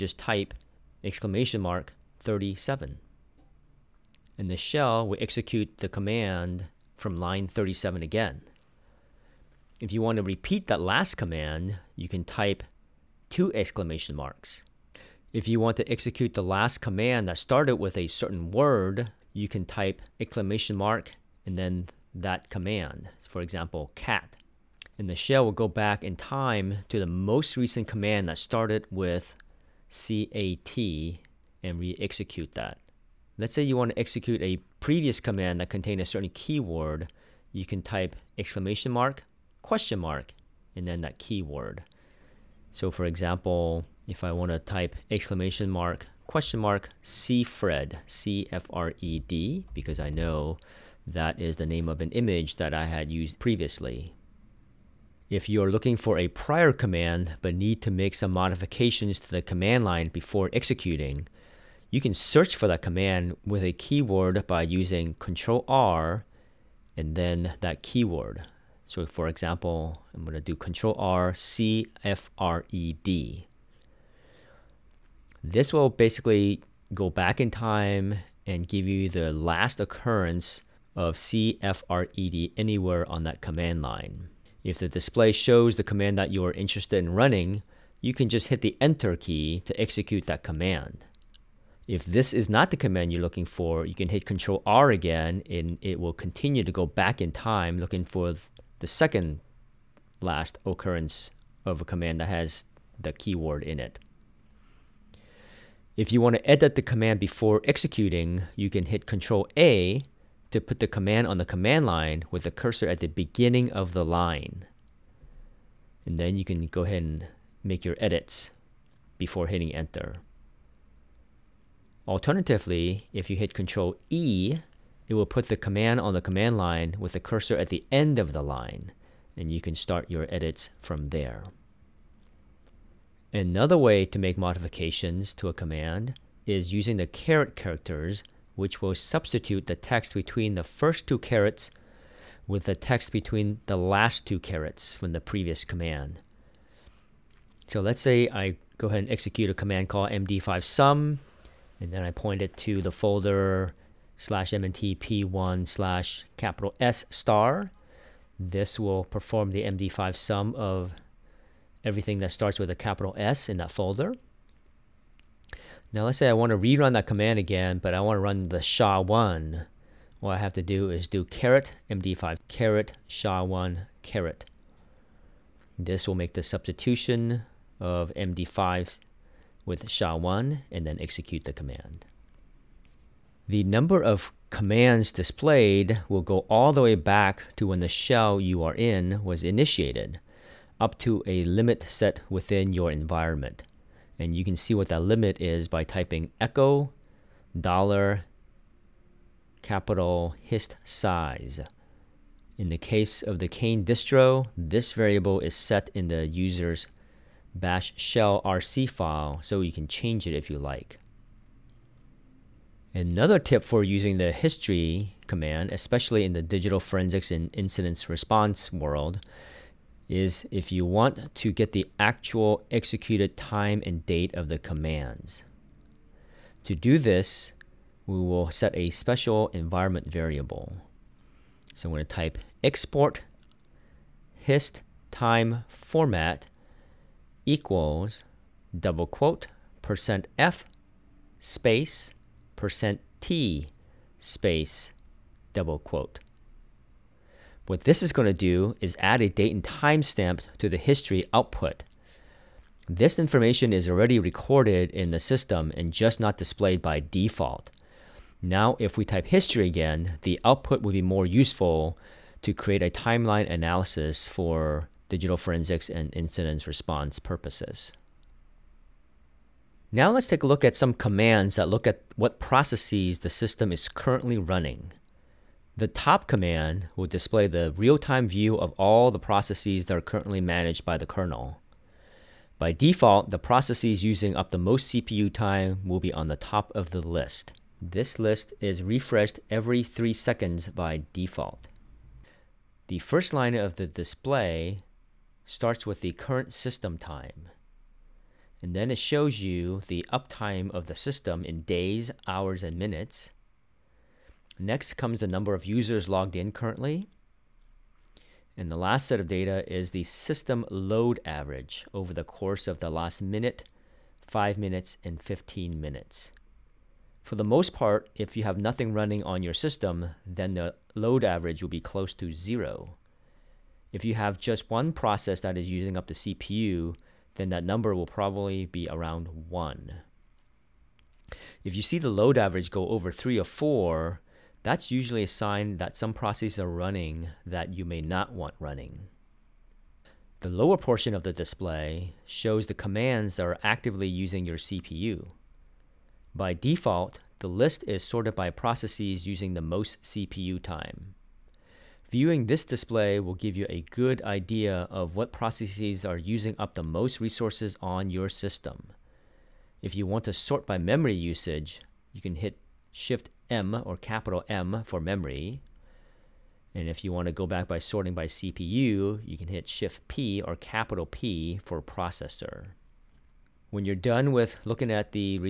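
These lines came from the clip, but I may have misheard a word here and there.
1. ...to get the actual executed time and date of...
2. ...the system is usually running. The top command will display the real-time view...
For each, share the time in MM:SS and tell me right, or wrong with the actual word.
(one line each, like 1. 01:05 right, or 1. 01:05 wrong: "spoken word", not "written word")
1. 03:41 right
2. 04:33 wrong: "currently", not "usually".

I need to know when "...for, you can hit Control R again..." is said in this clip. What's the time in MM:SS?
01:33.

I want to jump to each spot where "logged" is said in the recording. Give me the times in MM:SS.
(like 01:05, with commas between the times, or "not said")
05:06.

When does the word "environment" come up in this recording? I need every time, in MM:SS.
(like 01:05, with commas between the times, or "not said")
03:12, 03:49.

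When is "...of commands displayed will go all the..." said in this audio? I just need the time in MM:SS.
03:04.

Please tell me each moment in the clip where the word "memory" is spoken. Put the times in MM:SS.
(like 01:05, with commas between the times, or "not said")
06:00, 06:05.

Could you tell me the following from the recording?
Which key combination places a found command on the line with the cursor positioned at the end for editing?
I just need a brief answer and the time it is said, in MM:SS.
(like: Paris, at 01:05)
Control E, at 02:03.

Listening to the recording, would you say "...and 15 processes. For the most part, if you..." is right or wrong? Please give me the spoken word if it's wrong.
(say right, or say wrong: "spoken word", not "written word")
wrong: "minutes", not "processes".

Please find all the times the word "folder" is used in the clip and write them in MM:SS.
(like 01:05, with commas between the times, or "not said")
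02:32, 02:43.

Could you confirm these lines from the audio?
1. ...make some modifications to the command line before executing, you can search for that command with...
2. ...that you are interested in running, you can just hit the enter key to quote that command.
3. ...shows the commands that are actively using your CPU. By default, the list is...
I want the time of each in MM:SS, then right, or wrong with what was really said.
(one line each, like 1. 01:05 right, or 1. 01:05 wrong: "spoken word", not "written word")
1. 00:57 right
2. 01:26 wrong: "execute", not "quote"
3. 05:42 right.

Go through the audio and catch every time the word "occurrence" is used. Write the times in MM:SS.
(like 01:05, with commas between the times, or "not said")
01:19, 01:40.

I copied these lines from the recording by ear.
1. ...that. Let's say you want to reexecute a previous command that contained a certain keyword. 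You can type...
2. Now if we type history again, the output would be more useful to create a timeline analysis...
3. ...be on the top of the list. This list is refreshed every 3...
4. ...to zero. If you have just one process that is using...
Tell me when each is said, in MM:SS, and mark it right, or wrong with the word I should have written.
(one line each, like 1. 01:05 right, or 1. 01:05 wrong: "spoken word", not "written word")
1. 00:32 wrong: "execute", not "reexecute"
2. 04:18 right
3. 04:46 right
4. 05:22 right.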